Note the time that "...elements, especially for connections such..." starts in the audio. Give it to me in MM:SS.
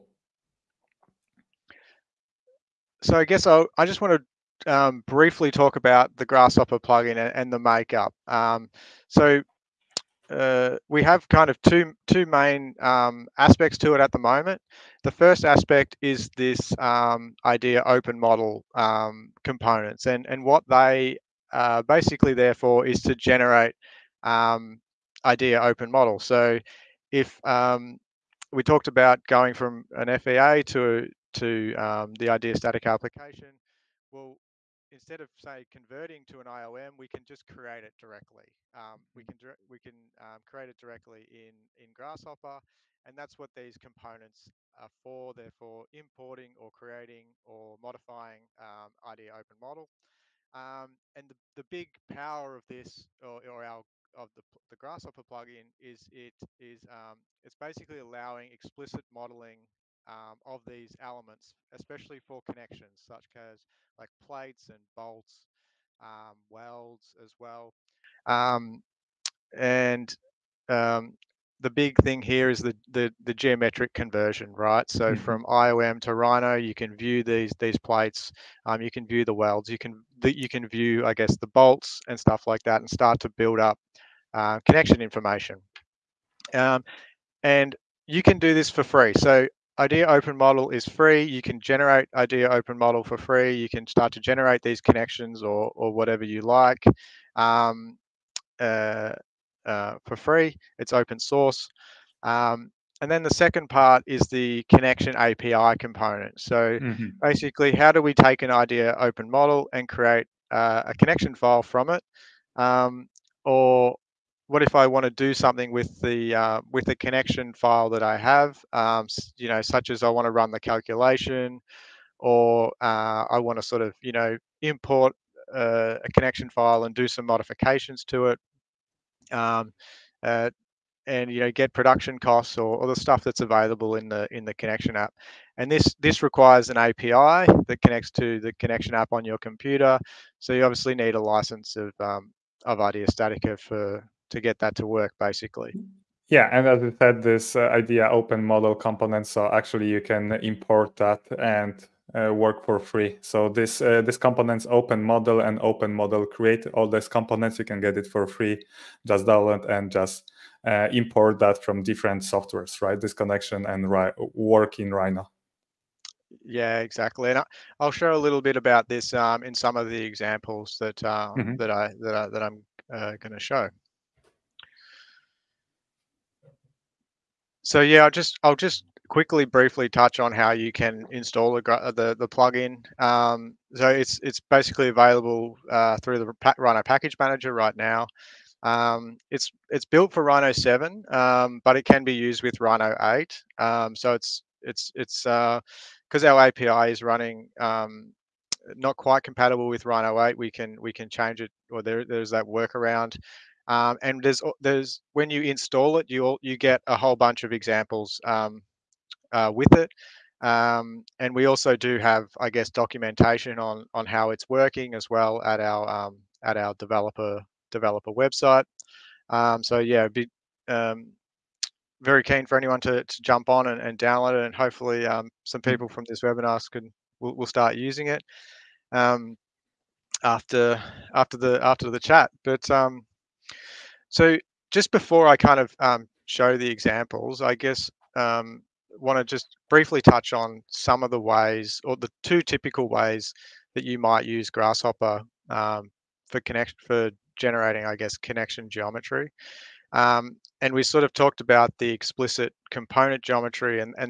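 01:00.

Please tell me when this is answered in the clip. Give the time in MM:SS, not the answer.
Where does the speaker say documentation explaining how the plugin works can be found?
03:37.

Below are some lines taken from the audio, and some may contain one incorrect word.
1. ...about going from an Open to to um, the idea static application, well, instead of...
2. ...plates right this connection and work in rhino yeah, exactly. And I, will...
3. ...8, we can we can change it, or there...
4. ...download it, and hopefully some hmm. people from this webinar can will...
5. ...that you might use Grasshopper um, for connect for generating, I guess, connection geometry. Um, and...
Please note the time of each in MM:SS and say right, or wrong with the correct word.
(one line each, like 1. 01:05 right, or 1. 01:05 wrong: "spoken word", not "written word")
1. 00:28 wrong: "FEA", not "Open"
2. 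02:42 wrong: "softwares", not "plates"
3. 03:20 right
4. 03:43 right
5. 04:03 right.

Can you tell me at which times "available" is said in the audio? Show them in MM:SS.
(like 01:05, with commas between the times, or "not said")
02:13, 03:04.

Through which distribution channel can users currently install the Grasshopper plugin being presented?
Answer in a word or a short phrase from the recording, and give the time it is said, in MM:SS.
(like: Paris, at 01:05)
Rhino Package Manager, at 03:06.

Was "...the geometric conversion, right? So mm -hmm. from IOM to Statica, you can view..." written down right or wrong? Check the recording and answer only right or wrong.
wrong.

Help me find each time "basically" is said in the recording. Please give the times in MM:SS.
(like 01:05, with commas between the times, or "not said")
00:21, 00:57, 01:47, 02:25, 03:04.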